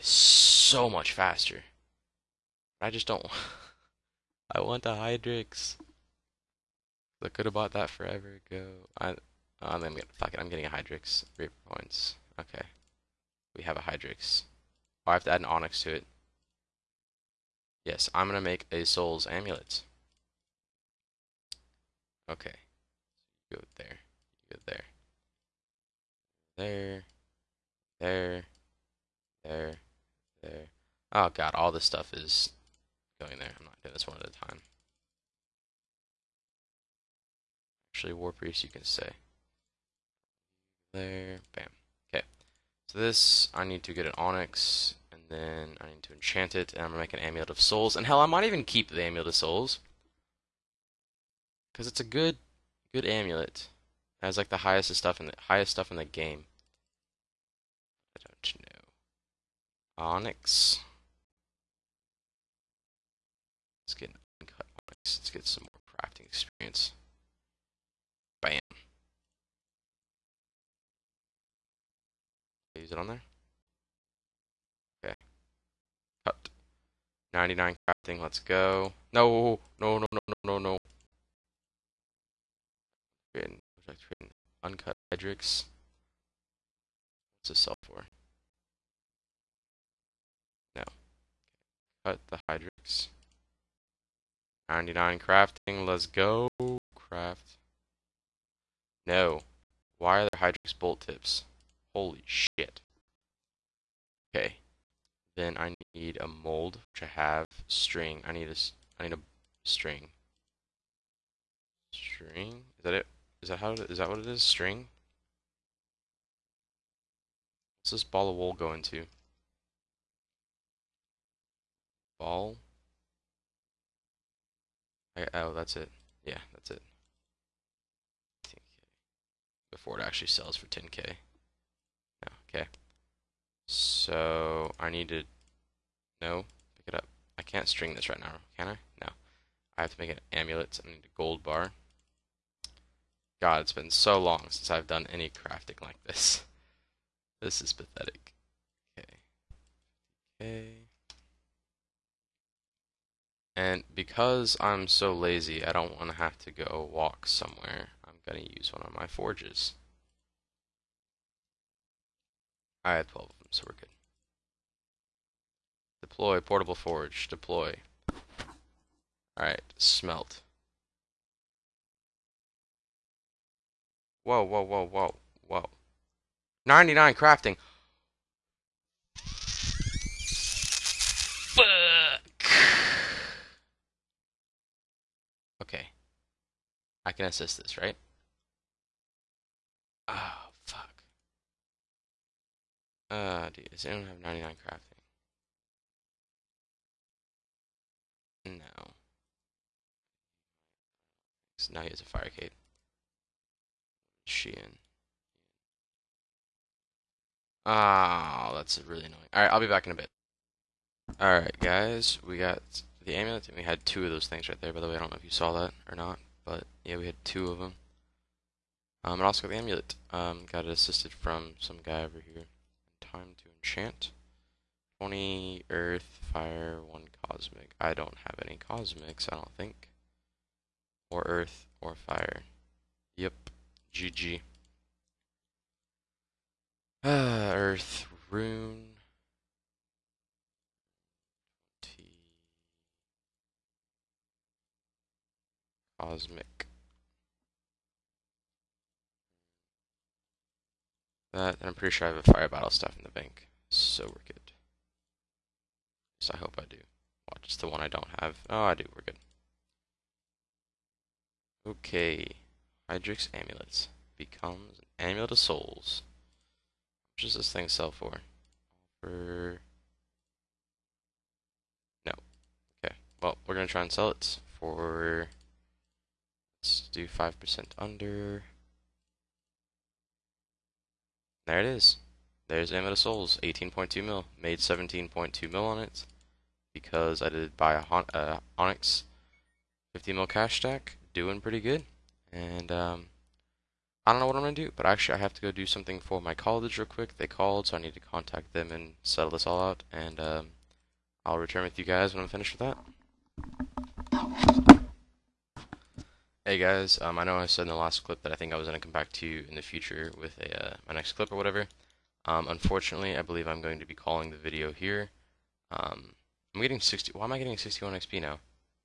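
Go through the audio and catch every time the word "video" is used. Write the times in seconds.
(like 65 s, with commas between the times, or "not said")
314 s.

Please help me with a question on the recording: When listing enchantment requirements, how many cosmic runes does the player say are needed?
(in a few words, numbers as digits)
1.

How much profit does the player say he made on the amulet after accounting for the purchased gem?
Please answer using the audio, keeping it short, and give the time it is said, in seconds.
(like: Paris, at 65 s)
17.2 mil, at 284 s.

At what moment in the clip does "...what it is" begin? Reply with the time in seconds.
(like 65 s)
114 s.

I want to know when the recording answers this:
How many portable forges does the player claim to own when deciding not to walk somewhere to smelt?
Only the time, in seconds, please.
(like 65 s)
162 s.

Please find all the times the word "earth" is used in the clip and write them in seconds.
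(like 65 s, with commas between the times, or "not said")
225 s, 231 s, 237 s.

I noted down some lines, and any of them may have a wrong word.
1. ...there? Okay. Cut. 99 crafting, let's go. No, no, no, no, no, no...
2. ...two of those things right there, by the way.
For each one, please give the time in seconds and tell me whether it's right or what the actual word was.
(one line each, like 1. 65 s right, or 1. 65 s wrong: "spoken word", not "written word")
1. 73 s right
2. 213 s right.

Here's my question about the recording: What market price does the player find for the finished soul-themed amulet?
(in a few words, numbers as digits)
18.2 mil.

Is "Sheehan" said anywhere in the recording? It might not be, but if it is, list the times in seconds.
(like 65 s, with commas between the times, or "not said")
204 s.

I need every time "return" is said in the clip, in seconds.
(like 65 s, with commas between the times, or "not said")
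301 s.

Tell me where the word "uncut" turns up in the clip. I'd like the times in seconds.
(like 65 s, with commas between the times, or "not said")
64 s, 84 s.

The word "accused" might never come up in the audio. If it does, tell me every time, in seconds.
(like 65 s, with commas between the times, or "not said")
not said.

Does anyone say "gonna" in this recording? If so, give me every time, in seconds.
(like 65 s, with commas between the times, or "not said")
9 s, 18 s, 46 s.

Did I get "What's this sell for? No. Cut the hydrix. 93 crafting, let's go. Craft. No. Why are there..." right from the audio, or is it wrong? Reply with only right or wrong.
wrong.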